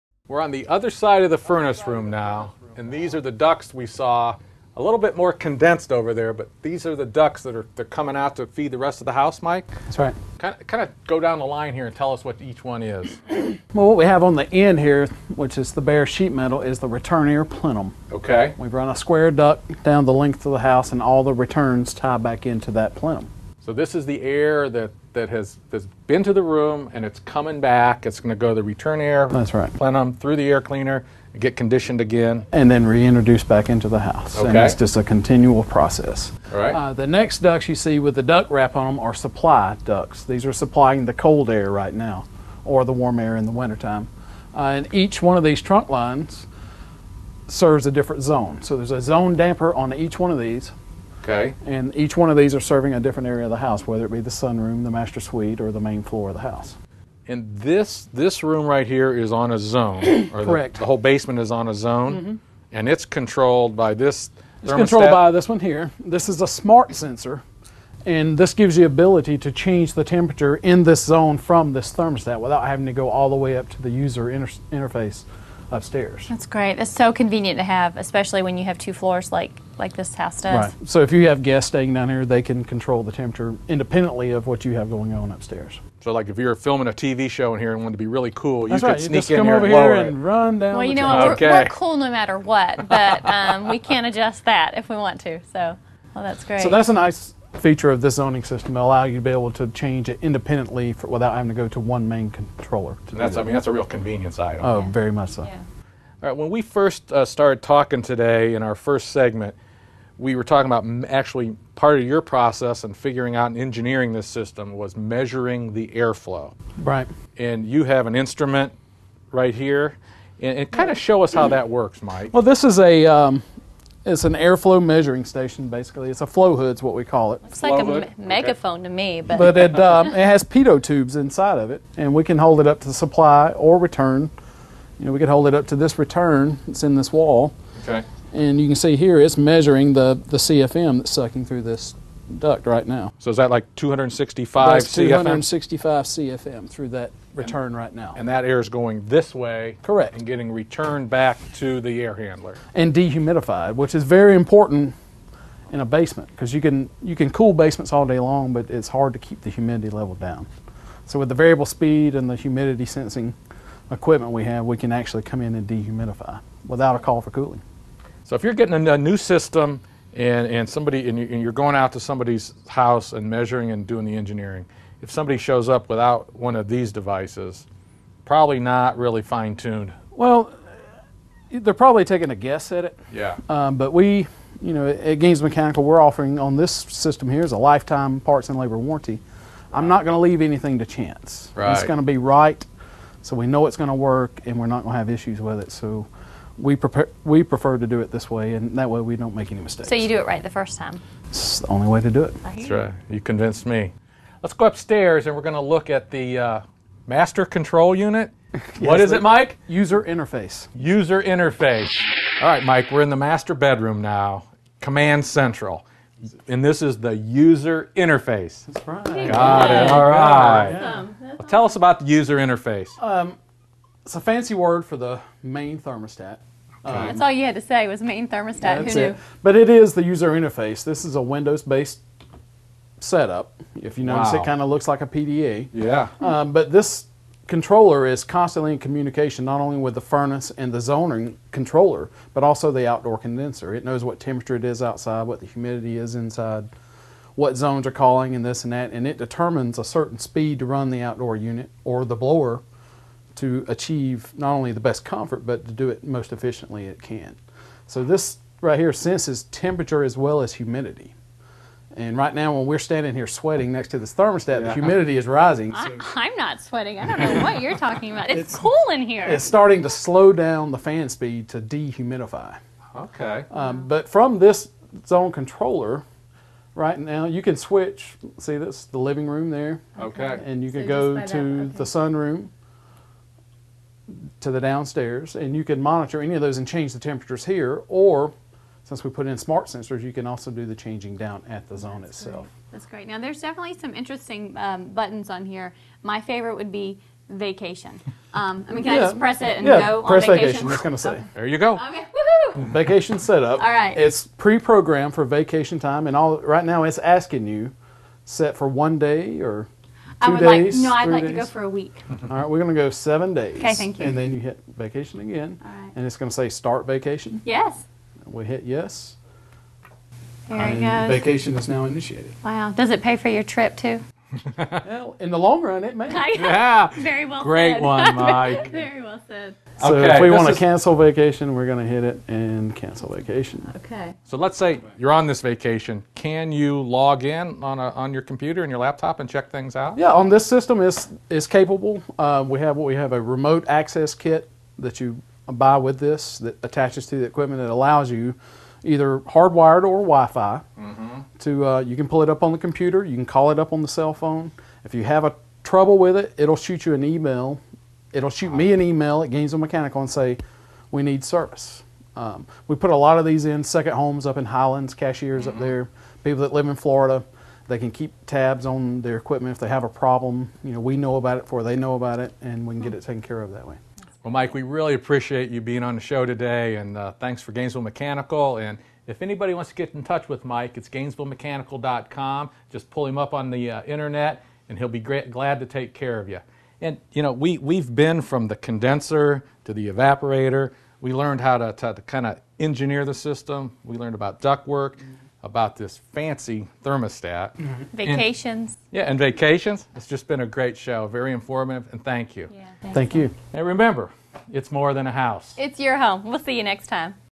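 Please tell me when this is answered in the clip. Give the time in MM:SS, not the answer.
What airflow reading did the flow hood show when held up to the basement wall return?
02:24.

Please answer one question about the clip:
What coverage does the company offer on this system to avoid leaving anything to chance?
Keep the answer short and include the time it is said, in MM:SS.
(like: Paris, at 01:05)
Lifetime parts and labor warranty, at 03:07.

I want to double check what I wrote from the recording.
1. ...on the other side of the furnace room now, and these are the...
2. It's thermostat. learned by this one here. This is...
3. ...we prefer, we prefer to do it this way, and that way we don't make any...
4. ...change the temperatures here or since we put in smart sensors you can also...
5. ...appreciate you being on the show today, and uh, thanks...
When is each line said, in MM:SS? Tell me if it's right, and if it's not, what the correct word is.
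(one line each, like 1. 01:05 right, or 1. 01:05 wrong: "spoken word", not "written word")
1. 00:00 right
2. 01:04 wrong: "controlled", not "learned"
3. 03:16 right
4. 04:46 right
5. 06:14 right.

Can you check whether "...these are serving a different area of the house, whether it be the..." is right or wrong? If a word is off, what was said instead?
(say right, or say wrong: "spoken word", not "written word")
right.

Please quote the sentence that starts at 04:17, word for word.
So this right here senses temperature as well as humidity.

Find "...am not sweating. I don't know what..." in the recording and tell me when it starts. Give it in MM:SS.
04:26.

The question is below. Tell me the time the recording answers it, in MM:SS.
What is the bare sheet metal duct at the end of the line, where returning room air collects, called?
00:16.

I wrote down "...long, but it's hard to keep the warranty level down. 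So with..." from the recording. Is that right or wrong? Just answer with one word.
wrong.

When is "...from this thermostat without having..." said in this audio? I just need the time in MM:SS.
01:11.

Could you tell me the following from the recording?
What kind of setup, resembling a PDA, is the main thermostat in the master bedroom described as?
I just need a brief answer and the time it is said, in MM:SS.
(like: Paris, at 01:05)
Windows-based, at 03:51.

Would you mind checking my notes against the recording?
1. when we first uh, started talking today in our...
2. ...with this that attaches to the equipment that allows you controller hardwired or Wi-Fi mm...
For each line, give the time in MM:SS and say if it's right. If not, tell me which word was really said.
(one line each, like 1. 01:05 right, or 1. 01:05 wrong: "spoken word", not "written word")
1. 01:46 right
2. 05:45 wrong: "either", not "controller".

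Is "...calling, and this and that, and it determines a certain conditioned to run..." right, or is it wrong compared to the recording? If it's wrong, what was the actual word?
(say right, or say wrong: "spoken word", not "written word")
wrong: "speed", not "conditioned".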